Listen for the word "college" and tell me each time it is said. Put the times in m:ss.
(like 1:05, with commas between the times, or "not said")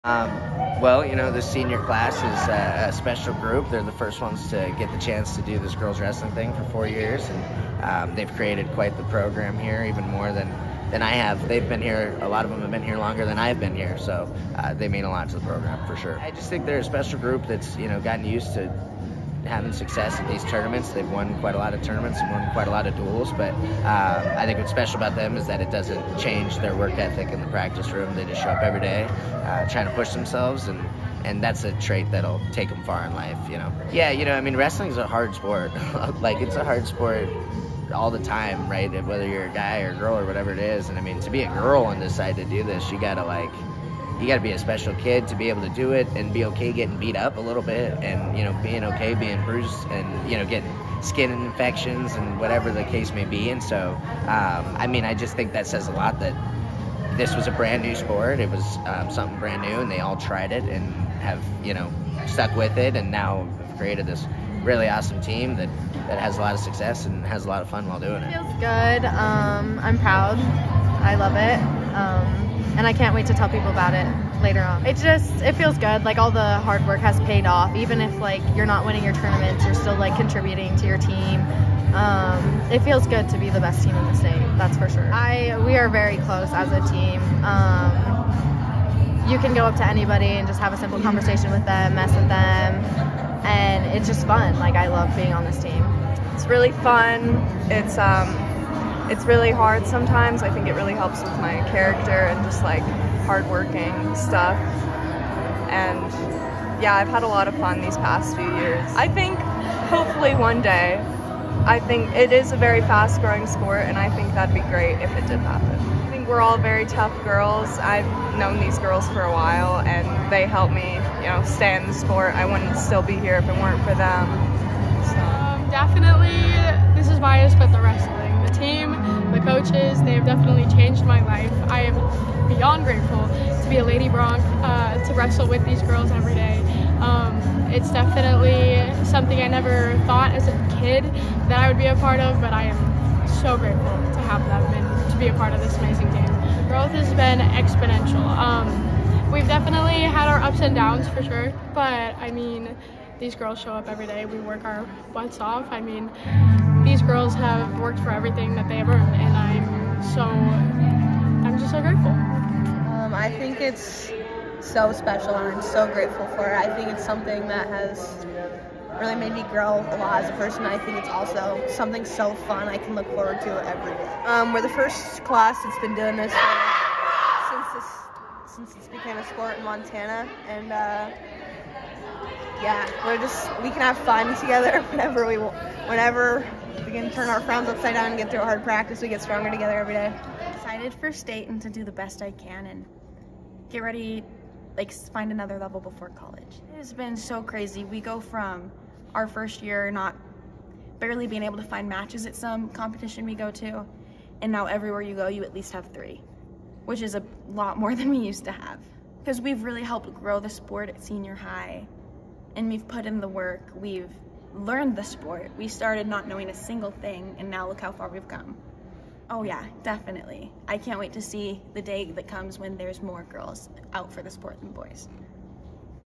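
3:16.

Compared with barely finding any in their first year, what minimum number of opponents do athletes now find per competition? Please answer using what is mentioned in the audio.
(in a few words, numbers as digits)
3.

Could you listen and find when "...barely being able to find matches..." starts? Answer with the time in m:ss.
3:20.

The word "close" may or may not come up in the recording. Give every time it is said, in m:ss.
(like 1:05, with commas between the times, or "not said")
1:26.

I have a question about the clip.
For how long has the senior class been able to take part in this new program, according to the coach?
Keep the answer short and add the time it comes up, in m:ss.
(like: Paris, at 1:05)
4 years, at 0:06.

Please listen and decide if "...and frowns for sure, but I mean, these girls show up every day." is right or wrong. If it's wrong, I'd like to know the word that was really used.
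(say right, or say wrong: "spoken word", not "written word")
wrong: "downs", not "frowns".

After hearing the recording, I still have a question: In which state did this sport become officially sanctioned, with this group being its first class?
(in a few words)
Montana.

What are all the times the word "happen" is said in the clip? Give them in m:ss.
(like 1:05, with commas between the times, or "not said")
1:55.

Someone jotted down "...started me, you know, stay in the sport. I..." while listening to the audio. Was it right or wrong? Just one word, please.
wrong.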